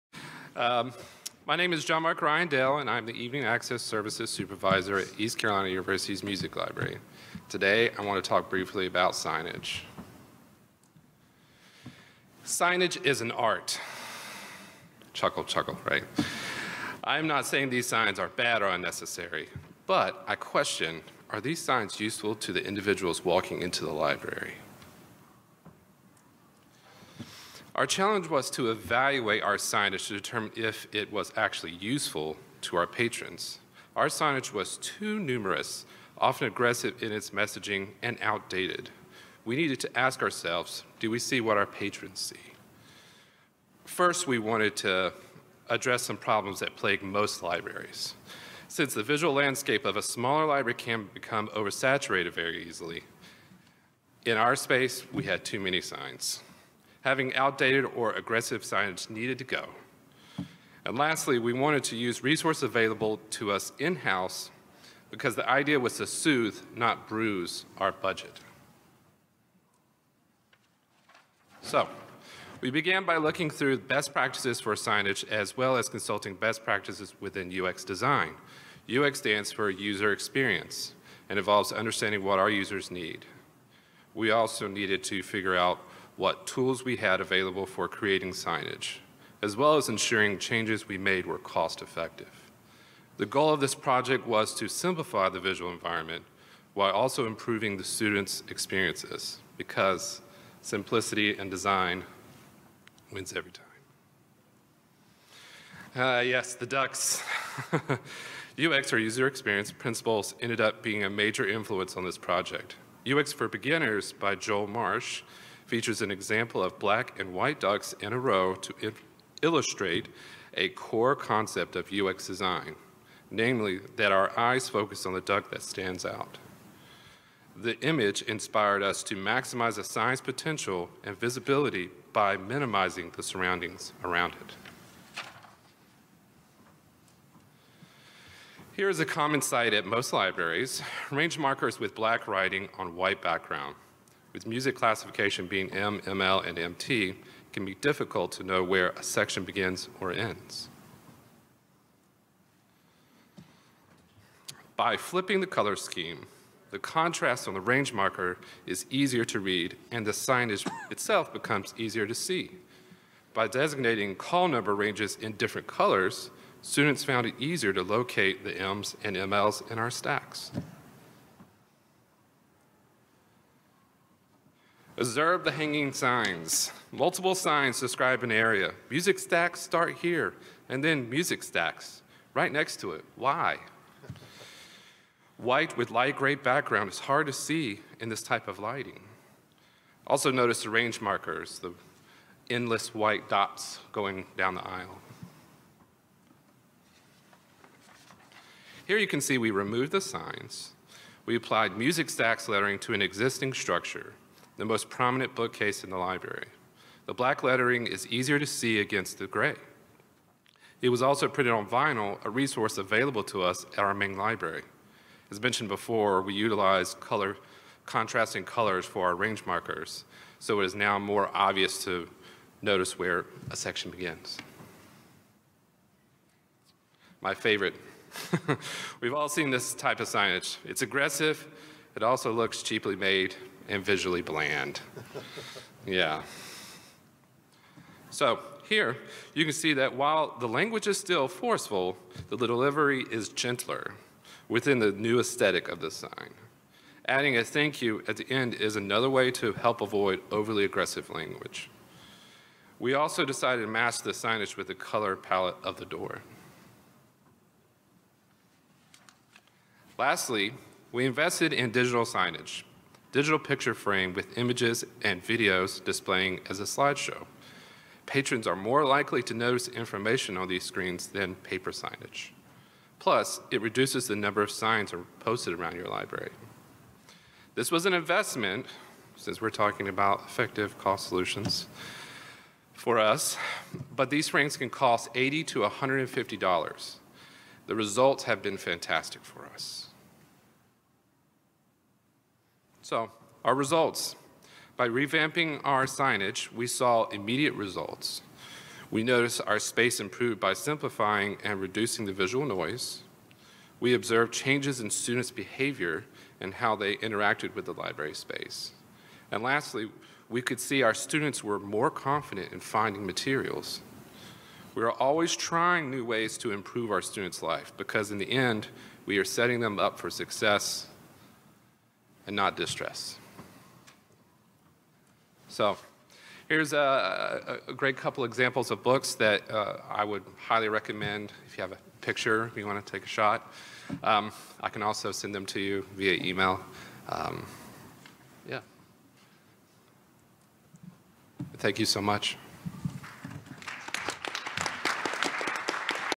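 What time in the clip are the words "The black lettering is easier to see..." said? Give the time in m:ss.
3:27.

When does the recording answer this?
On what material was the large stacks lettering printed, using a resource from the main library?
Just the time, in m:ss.
3:31.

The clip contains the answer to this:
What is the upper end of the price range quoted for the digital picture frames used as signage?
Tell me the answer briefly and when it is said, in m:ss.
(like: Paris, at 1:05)
$150, at 4:45.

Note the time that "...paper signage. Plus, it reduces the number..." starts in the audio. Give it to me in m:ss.
4:31.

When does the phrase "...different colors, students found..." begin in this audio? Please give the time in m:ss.
2:45.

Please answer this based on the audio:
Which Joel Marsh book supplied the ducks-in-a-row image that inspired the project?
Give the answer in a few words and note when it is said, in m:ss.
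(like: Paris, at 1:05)
UX for Beginners, at 1:53.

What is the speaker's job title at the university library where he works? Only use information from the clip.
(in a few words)
Evening Access Services Supervisor.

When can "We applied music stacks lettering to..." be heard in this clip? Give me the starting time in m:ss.
3:21.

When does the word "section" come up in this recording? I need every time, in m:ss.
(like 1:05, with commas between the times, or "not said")
2:29, 3:43.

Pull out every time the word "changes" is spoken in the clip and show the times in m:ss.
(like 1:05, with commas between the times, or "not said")
1:30, 5:04.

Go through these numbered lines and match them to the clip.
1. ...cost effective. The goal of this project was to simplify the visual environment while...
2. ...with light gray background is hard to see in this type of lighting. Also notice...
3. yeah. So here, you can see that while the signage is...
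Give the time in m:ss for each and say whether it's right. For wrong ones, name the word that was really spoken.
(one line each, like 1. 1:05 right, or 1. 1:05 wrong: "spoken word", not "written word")
1. 1:31 right
2. 3:05 right
3. 3:55 wrong: "language", not "signage".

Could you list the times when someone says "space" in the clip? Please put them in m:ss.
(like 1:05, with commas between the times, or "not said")
0:54, 4:59, 5:08.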